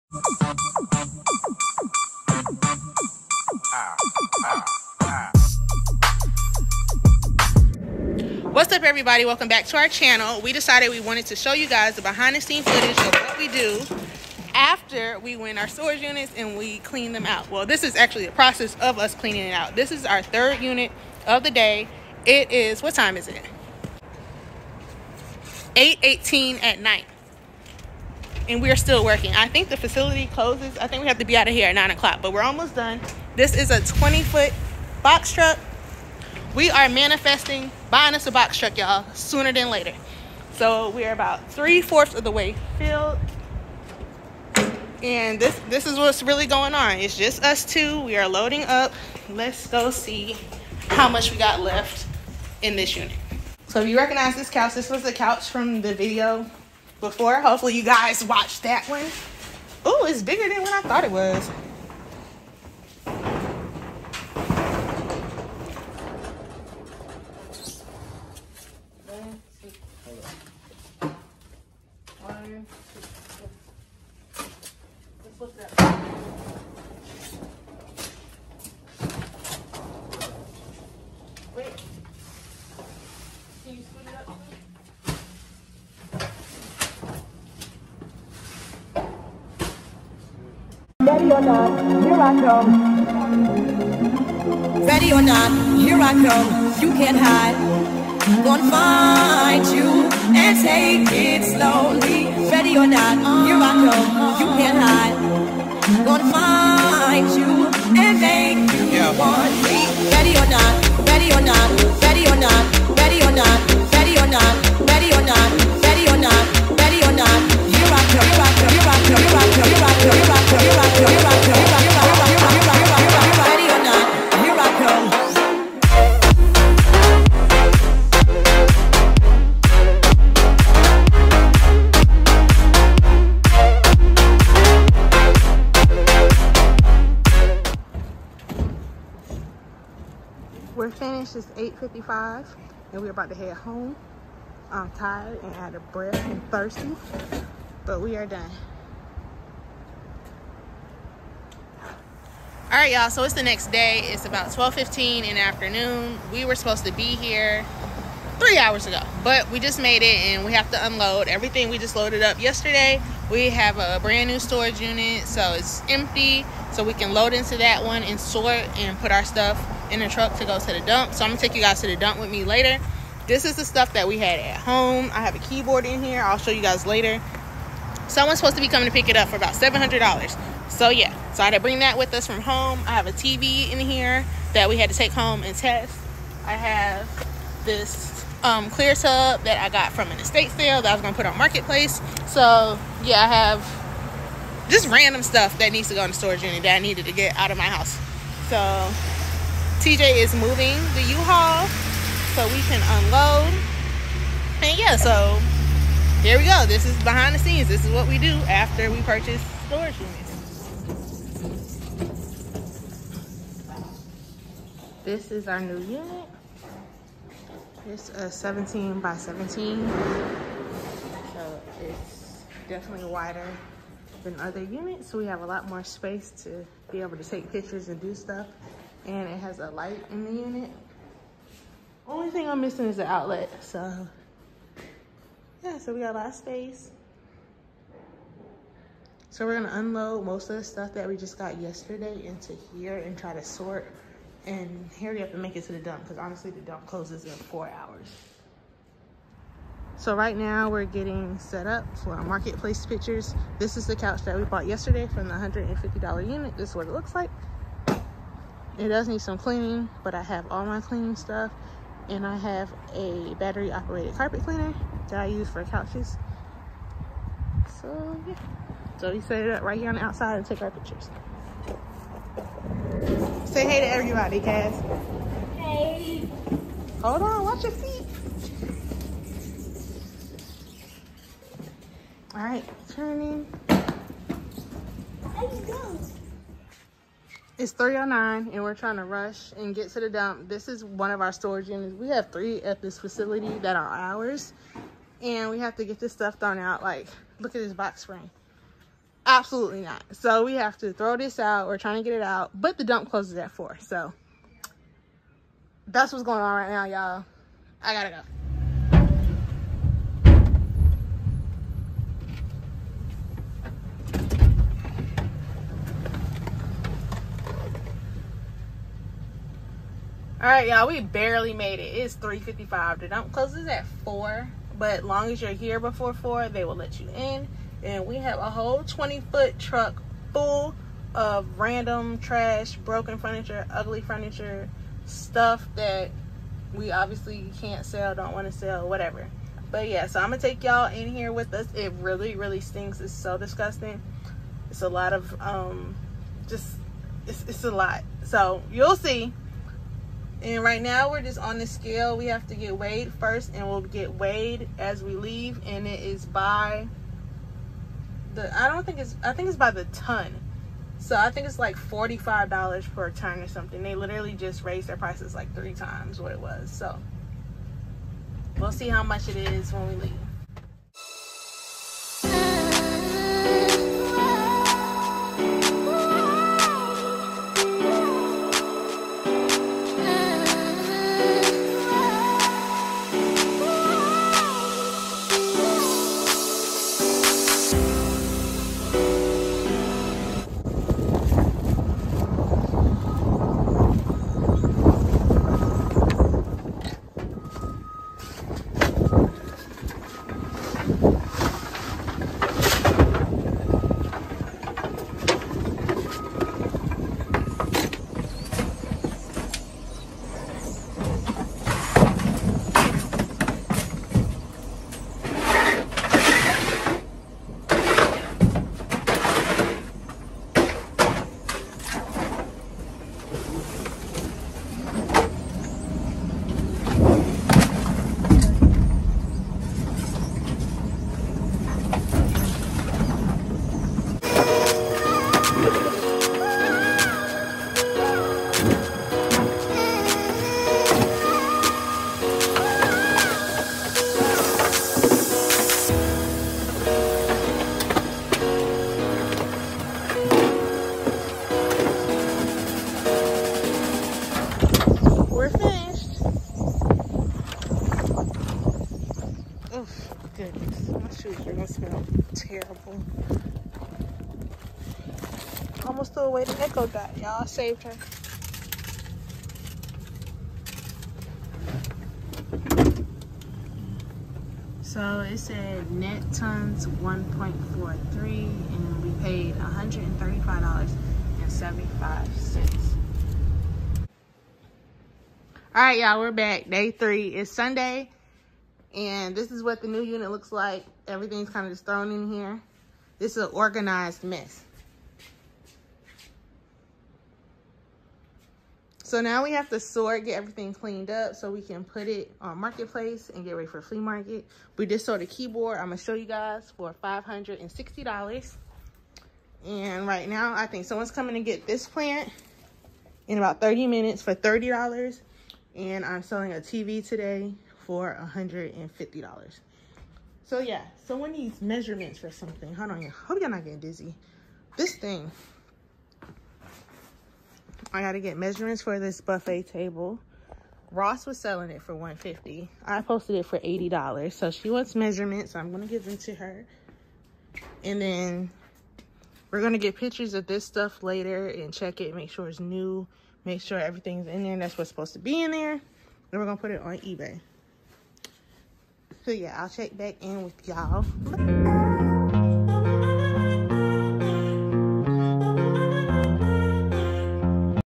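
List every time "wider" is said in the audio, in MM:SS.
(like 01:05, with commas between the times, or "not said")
03:43.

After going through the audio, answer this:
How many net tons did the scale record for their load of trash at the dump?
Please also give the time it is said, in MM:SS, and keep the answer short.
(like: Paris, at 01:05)
1.43, at 07:56.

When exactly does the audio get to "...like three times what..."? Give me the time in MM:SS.
06:05.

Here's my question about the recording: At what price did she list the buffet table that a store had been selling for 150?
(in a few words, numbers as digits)
$80.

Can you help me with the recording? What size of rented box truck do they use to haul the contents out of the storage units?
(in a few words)
20 foot.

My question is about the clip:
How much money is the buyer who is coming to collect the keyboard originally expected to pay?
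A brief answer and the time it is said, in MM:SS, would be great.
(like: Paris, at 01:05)
$700, at 02:59.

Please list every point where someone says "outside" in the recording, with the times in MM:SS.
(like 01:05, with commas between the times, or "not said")
04:30.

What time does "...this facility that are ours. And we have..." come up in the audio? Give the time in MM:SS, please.
04:52.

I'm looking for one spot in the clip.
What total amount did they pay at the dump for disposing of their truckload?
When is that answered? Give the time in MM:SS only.
07:59.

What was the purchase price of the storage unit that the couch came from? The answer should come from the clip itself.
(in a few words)
$150.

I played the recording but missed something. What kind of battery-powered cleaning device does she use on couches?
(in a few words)
carpet cleaner.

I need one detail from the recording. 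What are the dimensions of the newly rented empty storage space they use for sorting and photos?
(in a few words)
17 by 17.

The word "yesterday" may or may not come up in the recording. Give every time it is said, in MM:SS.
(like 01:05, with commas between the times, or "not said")
02:42, 04:01, 04:14.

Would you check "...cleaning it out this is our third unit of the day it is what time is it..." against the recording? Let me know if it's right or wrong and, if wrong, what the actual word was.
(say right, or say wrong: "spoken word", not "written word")
right.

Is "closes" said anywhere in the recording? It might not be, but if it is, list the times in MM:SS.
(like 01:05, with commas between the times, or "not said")
00:30, 04:06, 05:03, 05:23.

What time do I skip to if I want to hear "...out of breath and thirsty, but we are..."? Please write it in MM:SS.
02:25.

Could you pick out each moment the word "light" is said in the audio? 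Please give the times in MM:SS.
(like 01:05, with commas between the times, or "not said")
03:49.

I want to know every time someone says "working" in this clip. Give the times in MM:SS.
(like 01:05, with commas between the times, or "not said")
00:29.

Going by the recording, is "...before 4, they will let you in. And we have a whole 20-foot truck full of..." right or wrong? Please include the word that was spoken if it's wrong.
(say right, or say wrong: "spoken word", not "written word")
right.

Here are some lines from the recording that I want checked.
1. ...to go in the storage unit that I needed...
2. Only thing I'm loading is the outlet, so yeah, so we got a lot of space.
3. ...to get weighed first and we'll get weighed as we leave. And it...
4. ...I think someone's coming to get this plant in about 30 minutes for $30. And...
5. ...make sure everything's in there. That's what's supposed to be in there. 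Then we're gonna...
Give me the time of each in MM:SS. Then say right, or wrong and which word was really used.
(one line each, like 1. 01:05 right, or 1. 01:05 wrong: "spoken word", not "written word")
1. 03:15 right
2. 03:52 wrong: "missing", not "loading"
3. 05:52 right
4. 08:30 right
5. 09:03 right.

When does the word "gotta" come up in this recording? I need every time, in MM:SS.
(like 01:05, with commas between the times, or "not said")
05:07, 08:47.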